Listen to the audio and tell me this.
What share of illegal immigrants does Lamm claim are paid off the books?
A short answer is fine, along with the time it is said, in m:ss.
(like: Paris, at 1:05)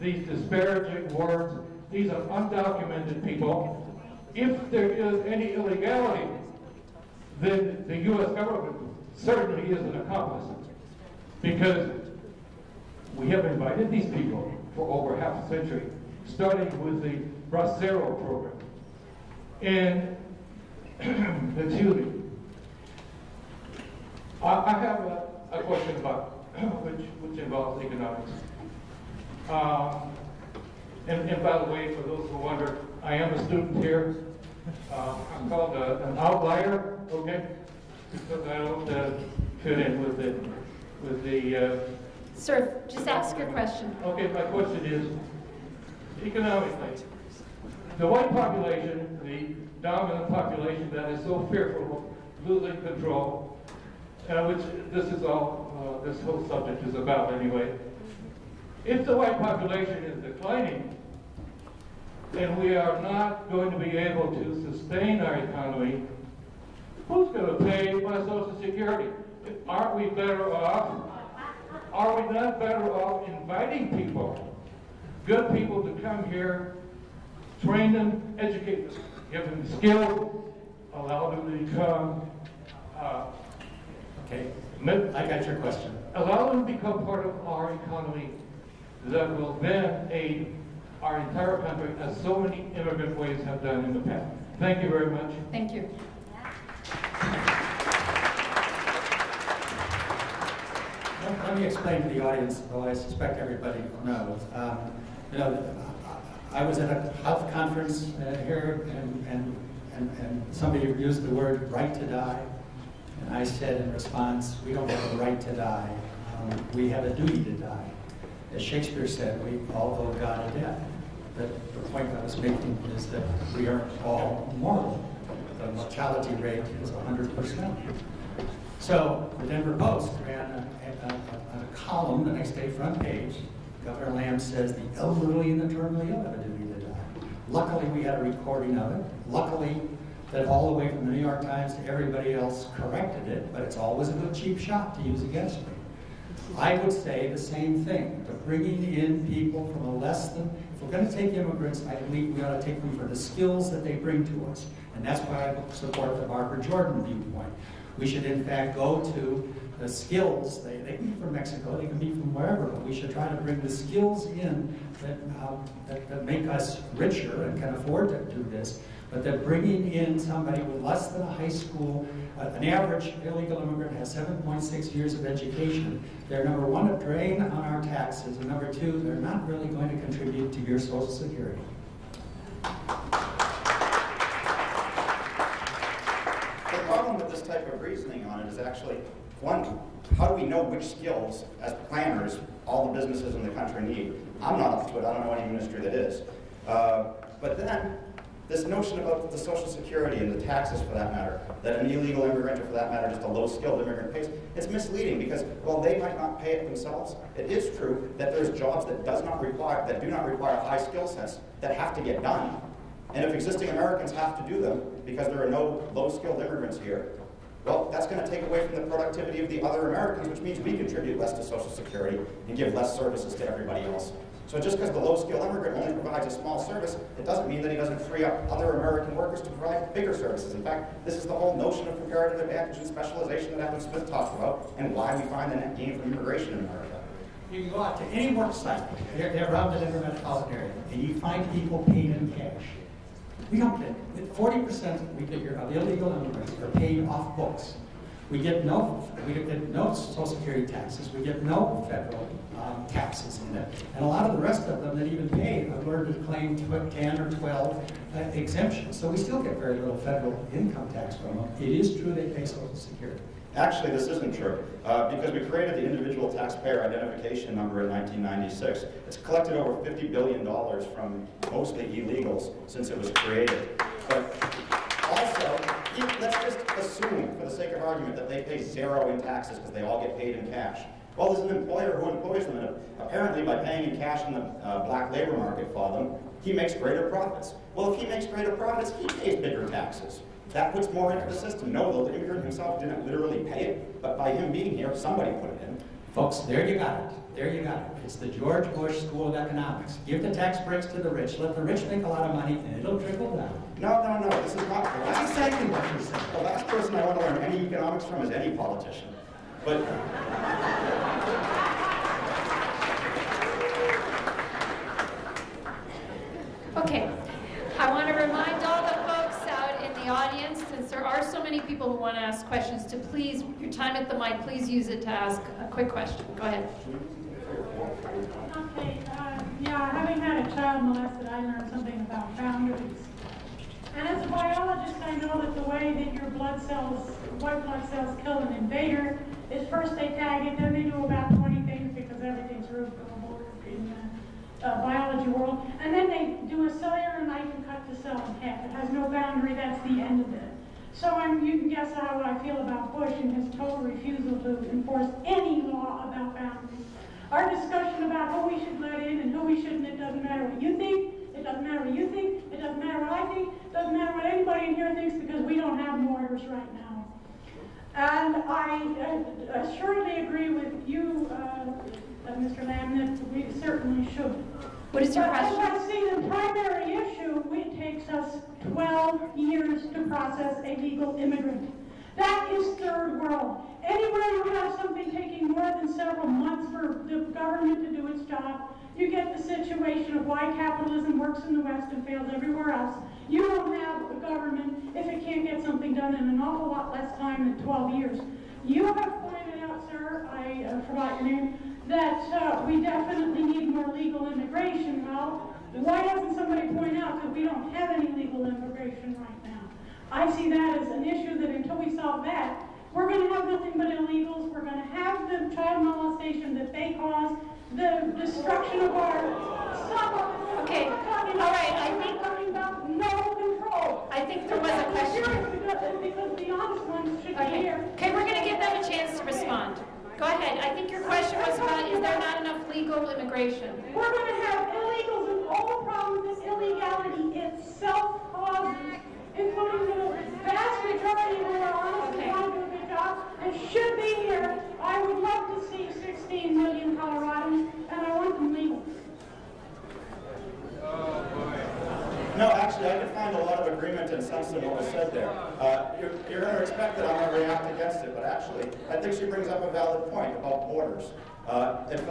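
40%, at 4:04.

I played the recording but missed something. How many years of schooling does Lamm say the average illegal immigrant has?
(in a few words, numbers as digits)
7.6 years.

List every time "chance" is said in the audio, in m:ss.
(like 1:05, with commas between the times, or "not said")
7:08.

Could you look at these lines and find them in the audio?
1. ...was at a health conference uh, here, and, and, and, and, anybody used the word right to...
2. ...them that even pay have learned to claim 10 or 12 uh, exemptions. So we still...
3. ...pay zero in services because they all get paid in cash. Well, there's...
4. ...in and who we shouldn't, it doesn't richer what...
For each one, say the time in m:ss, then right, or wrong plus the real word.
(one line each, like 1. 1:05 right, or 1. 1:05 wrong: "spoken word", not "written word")
1. 1:46 wrong: "somebody", not "anybody"
2. 4:14 right
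3. 4:38 wrong: "taxes", not "services"
4. 5:59 wrong: "matter", not "richer".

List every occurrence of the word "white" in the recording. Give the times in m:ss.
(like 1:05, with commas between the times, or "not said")
0:48, 0:59, 5:37.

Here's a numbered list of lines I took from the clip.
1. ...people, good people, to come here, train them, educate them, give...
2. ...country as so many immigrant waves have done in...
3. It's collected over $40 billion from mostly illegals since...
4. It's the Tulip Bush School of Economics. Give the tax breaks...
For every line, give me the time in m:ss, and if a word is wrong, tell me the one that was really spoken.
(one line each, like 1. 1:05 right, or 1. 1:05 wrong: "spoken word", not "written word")
1. 1:13 right
2. 1:31 right
3. 4:29 wrong: "50", not "40"
4. 4:58 wrong: "George", not "Tulip".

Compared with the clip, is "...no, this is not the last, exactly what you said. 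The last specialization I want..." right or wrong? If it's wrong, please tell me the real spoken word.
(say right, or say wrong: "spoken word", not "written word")
wrong: "person", not "specialization".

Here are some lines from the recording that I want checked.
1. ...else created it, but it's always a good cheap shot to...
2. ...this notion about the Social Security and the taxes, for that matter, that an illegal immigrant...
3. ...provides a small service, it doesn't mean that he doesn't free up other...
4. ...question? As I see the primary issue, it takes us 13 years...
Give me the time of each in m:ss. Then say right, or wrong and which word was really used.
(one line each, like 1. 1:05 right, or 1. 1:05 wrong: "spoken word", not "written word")
1. 2:22 wrong: "corrected", not "created"
2. 3:18 right
3. 3:45 right
4. 6:15 wrong: "12", not "13".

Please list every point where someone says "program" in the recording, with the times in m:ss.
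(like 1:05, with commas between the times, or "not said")
0:18.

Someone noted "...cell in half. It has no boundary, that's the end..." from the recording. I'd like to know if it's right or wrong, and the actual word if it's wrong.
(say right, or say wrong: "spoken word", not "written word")
right.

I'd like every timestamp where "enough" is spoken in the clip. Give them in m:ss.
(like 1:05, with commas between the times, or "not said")
7:12.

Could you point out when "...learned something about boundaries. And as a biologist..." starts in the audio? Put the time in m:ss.
5:31.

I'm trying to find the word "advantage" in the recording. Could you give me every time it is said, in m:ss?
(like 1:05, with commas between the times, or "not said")
3:52.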